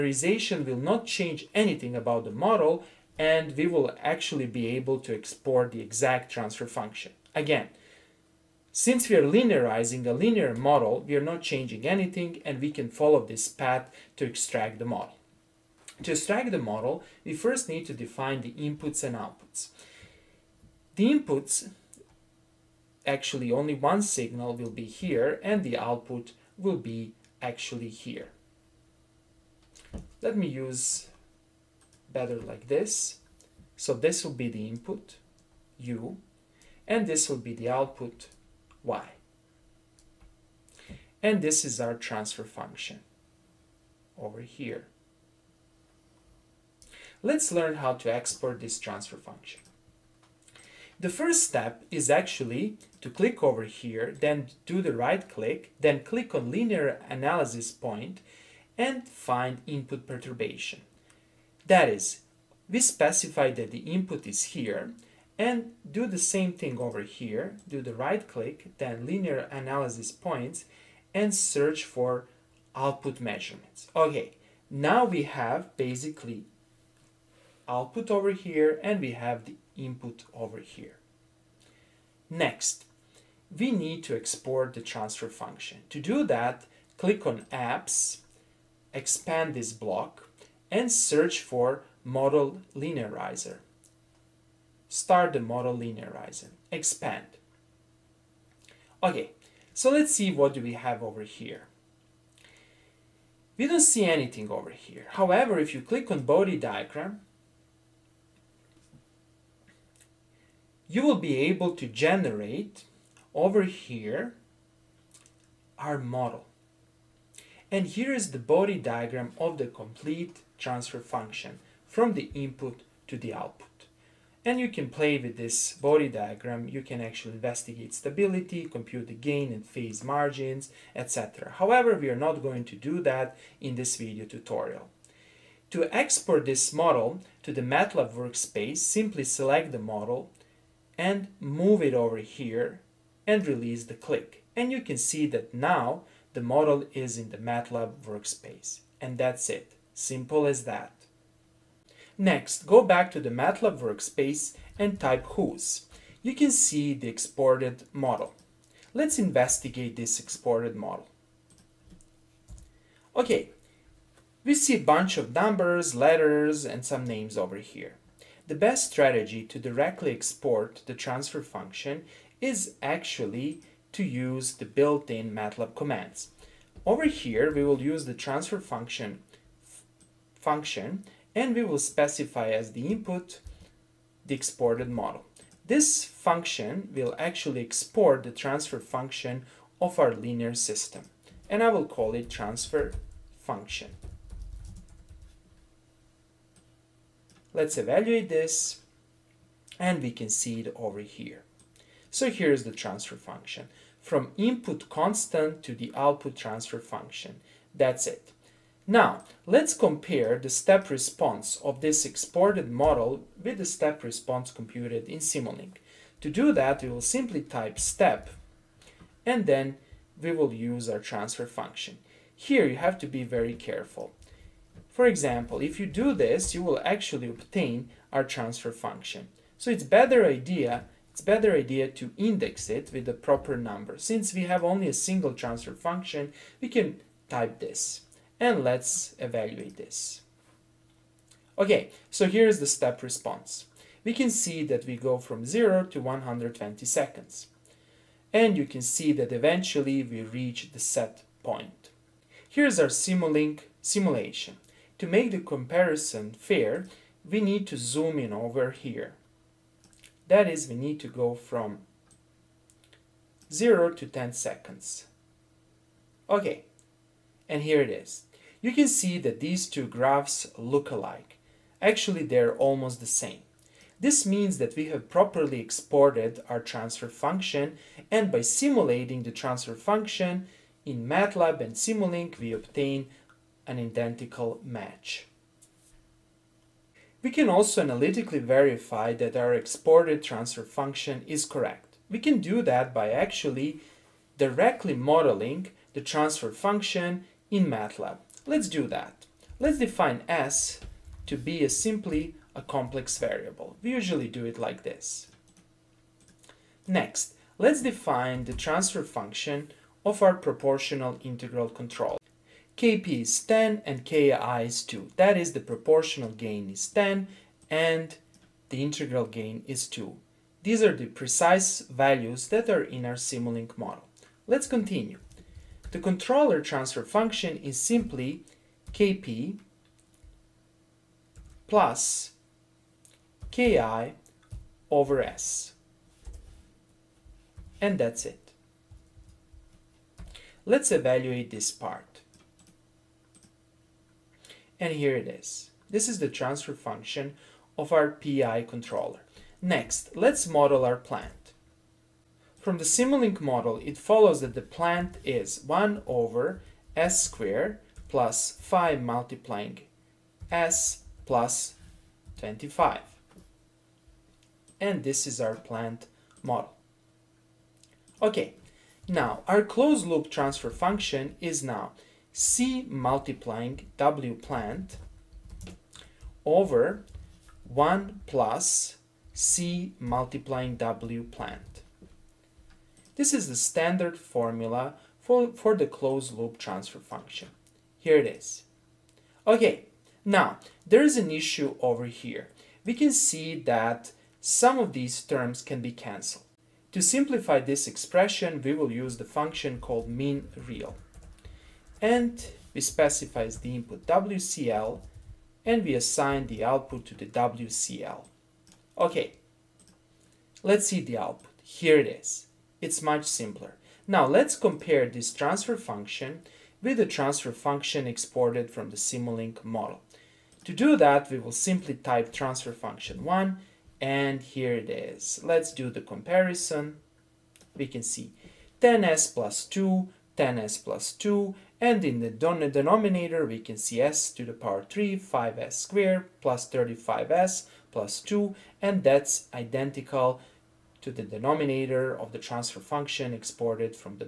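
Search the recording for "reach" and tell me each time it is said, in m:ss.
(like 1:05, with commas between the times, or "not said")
4:10.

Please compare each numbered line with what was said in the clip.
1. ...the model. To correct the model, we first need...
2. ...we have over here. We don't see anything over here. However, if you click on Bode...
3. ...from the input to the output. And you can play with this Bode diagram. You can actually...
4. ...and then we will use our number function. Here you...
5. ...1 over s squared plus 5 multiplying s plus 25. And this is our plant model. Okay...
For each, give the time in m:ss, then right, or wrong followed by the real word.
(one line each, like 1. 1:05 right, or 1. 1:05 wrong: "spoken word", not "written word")
1. 0:14 wrong: "extract", not "correct"
2. 1:40 right
3. 2:01 right
4. 3:39 wrong: "transfer", not "number"
5. 5:55 right.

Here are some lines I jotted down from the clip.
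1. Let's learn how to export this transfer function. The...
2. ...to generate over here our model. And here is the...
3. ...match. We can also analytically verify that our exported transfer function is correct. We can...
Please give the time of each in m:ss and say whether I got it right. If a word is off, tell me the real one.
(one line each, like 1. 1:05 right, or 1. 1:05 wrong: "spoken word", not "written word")
1. 0:47 right
2. 1:51 right
3. 4:44 right.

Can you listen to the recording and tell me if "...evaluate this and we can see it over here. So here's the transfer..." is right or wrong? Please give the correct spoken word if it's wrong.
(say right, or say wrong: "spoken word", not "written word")
right.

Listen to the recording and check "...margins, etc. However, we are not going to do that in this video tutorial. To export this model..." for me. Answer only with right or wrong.
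right.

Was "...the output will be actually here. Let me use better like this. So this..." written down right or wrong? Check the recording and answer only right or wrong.
right.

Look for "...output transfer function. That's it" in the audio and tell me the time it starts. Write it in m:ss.
3:25.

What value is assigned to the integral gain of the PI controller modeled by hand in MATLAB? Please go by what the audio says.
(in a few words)
2.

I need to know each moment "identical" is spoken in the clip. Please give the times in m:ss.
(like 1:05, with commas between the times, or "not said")
4:43, 7:19.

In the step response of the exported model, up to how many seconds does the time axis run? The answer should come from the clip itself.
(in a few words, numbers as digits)
120 seconds.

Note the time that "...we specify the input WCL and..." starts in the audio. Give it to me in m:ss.
6:42.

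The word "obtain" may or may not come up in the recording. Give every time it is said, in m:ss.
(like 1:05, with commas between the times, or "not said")
3:47, 4:42.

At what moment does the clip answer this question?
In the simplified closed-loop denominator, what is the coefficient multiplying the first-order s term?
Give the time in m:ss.
7:16.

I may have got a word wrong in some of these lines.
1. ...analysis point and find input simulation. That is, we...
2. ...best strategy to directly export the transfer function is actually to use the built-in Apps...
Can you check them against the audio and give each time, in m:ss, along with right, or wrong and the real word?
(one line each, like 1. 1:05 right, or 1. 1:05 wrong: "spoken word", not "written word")
1. 0:57 wrong: "perturbation", not "simulation"
2. 2:48 wrong: "MATLAB", not "Apps".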